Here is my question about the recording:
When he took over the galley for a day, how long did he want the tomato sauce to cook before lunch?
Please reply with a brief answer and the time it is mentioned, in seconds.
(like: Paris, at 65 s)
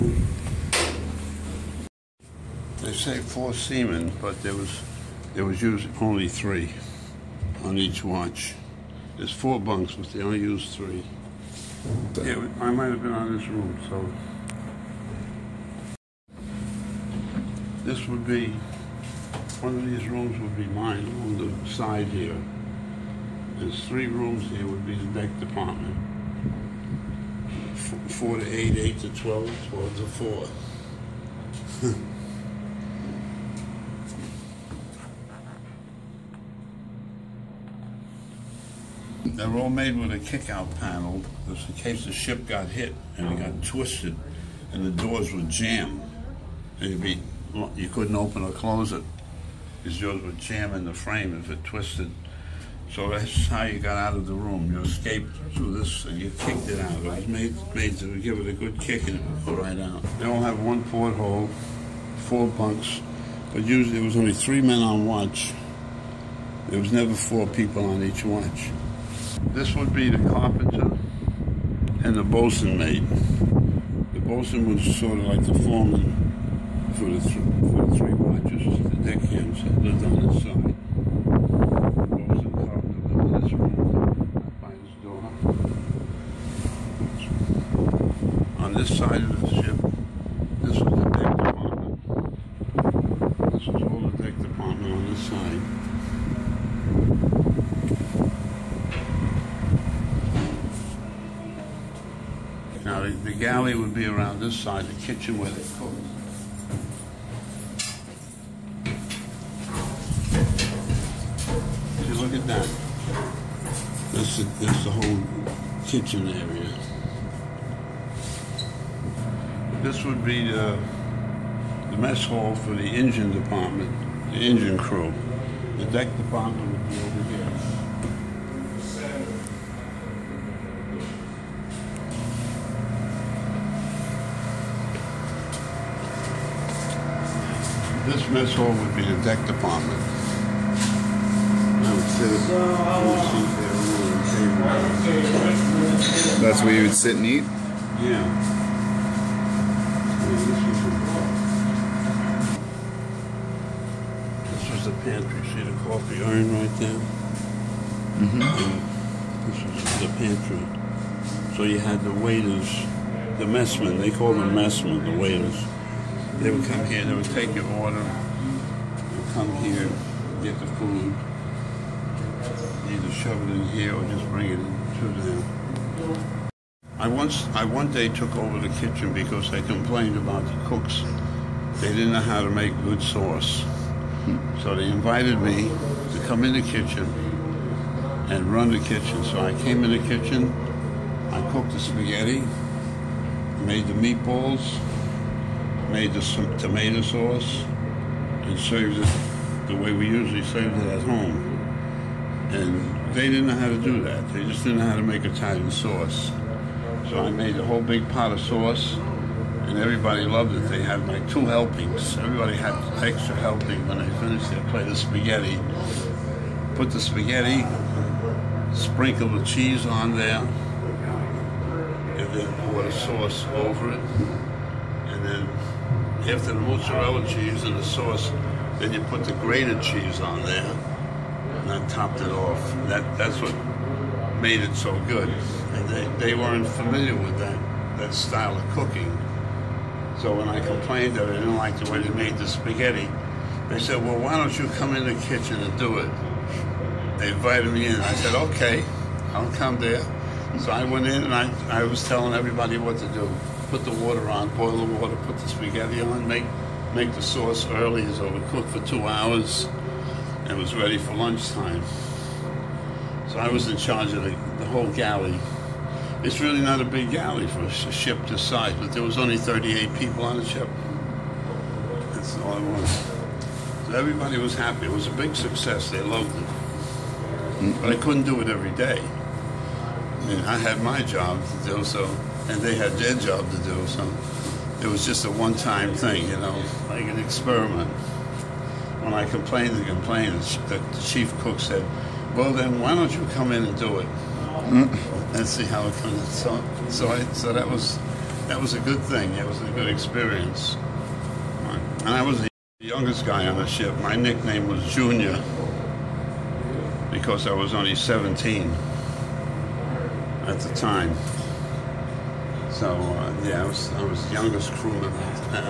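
2 hours, at 258 s.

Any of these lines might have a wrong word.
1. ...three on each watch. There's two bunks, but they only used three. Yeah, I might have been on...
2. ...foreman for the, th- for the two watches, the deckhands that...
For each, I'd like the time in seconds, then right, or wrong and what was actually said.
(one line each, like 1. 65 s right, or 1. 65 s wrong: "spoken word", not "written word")
1. 6 s wrong: "four", not "two"
2. 75 s wrong: "three", not "two".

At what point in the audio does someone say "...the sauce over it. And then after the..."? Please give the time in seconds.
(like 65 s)
222 s.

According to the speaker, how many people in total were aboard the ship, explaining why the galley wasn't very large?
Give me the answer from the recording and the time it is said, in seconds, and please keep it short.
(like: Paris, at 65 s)
38, at 269 s.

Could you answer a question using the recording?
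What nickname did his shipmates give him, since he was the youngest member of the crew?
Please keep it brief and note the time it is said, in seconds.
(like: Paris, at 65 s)
Junior, at 304 s.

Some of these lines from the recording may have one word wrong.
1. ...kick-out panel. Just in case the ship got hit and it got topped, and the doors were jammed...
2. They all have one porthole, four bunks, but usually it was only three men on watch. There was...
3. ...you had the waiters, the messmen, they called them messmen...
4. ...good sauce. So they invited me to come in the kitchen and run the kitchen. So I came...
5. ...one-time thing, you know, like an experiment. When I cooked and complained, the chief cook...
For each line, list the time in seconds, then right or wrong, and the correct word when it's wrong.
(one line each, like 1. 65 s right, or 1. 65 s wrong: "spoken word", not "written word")
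1. 40 s wrong: "twisted", not "topped"
2. 60 s right
3. 161 s right
4. 182 s right
5. 285 s wrong: "complained", not "cooked".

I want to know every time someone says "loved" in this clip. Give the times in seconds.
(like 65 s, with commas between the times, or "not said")
210 s, 276 s.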